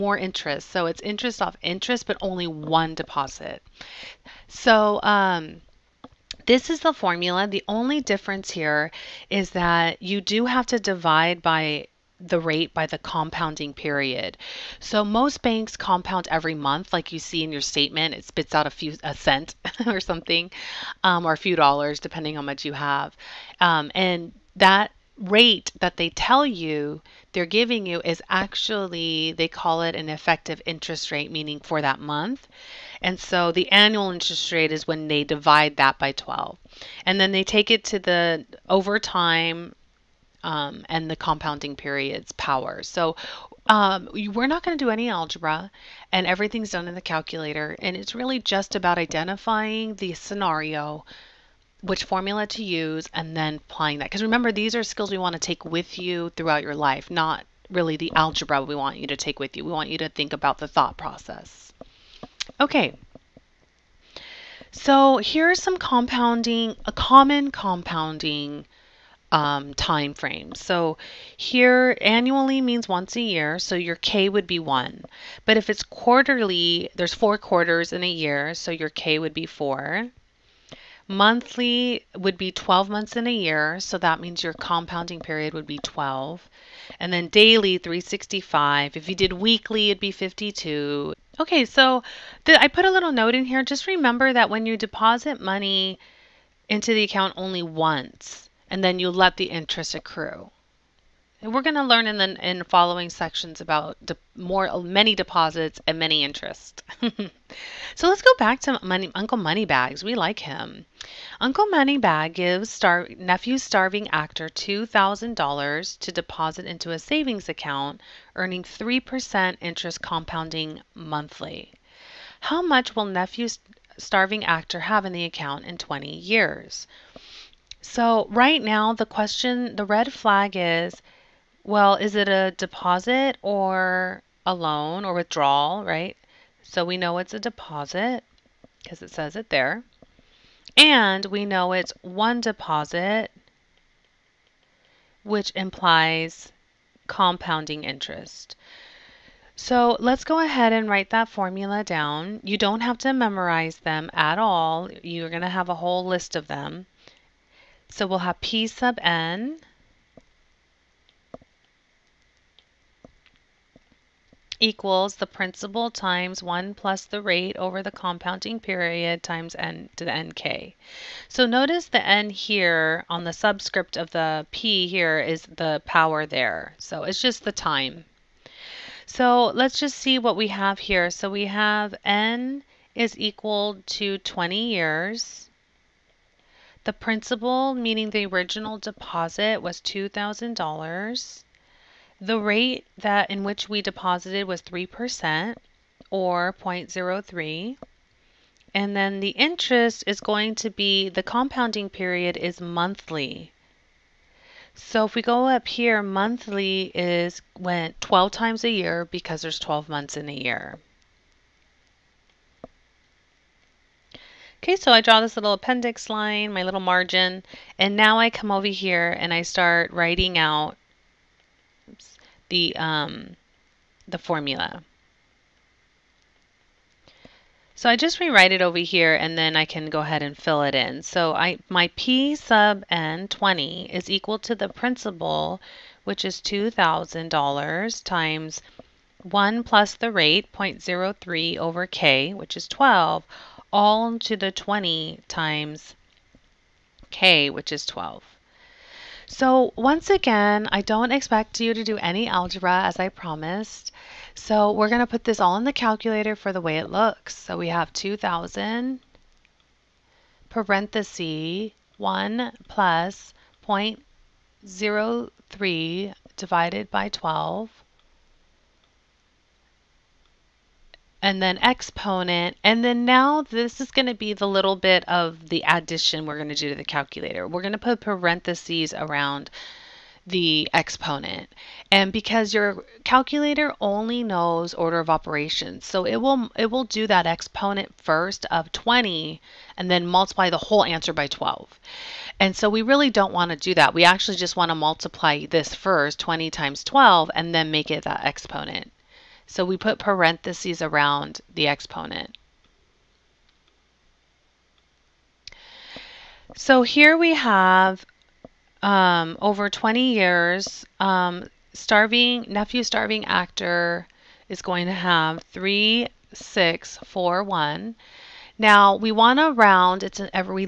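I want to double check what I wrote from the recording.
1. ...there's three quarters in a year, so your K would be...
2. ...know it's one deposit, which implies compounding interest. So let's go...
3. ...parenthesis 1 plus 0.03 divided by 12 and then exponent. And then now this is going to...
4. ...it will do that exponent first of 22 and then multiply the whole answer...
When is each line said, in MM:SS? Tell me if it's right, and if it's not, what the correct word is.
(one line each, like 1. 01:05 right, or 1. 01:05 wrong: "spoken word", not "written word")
1. 01:16 wrong: "four", not "three"
2. 02:21 right
3. 04:20 right
4. 04:46 wrong: "20", not "22".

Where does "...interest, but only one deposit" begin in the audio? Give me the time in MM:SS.
00:01.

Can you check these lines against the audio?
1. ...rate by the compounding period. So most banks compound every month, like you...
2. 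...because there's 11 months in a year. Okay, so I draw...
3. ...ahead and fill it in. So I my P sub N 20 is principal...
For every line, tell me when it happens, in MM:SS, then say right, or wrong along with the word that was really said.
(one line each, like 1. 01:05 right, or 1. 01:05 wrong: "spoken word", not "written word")
1. 00:12 right
2. 03:29 wrong: "12", not "11"
3. 03:49 wrong: "equal", not "principal".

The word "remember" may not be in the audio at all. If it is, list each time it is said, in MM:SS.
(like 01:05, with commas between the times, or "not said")
00:54, 01:33.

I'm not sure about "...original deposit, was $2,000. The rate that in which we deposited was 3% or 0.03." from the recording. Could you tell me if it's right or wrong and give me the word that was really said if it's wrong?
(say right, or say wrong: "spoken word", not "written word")
right.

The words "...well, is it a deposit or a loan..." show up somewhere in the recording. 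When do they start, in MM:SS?
02:11.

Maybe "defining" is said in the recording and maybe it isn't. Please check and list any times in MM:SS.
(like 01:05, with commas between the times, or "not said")
not said.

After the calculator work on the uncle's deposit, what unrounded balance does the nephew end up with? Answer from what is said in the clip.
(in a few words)
3641.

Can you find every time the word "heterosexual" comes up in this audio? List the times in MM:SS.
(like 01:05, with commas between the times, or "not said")
not said.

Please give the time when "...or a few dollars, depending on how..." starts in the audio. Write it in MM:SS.
00:21.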